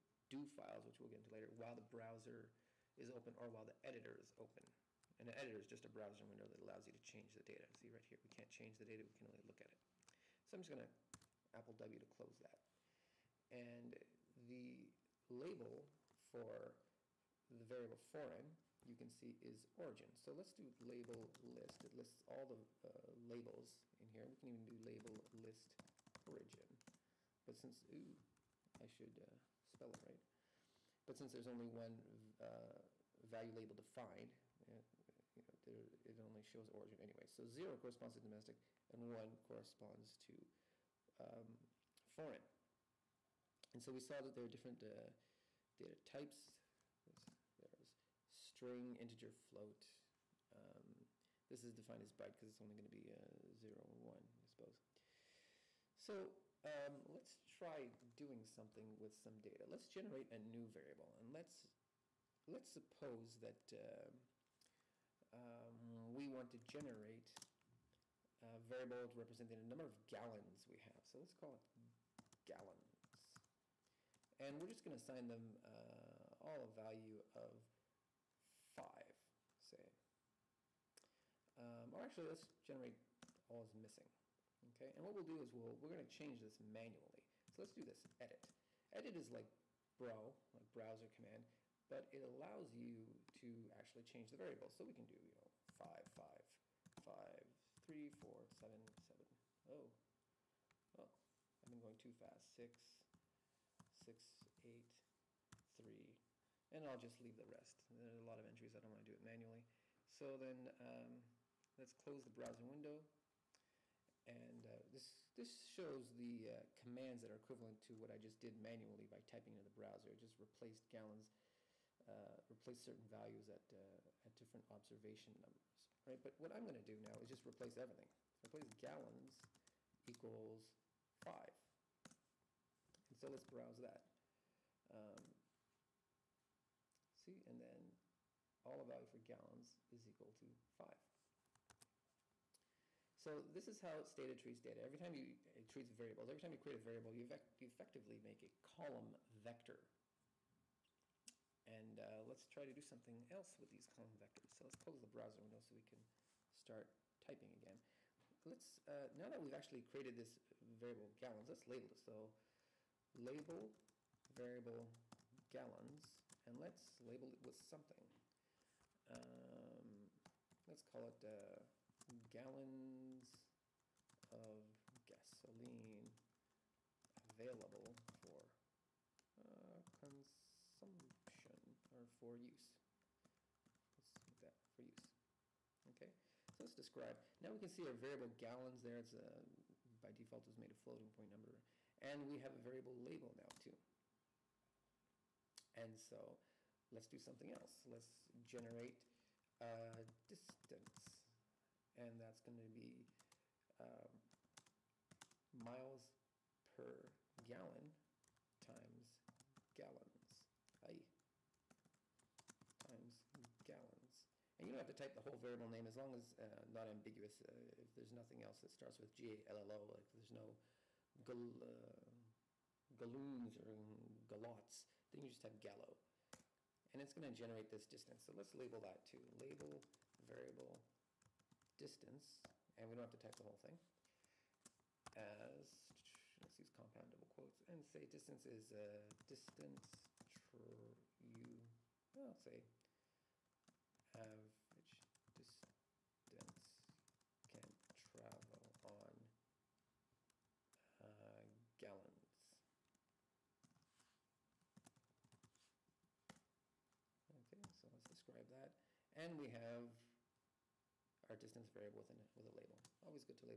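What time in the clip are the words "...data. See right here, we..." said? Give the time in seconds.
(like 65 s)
7 s.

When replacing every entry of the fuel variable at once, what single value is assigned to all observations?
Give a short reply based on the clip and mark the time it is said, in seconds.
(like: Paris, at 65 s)
5, at 128 s.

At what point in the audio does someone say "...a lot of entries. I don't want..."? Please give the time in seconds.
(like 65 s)
108 s.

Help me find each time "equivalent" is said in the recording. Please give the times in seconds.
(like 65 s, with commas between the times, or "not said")
117 s.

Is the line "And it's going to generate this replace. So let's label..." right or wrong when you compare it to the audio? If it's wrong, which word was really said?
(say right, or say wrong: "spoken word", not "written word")
wrong: "distance", not "replace".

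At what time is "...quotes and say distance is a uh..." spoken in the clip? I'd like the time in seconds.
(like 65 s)
237 s.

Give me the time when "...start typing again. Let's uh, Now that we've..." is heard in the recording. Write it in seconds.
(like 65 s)
156 s.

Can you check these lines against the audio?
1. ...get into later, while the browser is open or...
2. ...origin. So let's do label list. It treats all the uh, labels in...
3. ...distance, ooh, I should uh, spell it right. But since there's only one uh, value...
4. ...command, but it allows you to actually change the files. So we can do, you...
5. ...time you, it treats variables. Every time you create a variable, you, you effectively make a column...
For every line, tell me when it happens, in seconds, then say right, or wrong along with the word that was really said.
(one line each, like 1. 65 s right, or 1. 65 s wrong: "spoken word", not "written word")
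1. 1 s right
2. 19 s wrong: "lists", not "treats"
3. 27 s wrong: "since", not "distance"
4. 91 s wrong: "variables", not "files"
5. 145 s right.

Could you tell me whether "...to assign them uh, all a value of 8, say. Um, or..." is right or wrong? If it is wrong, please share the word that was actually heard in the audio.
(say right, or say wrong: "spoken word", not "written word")
wrong: "5", not "8".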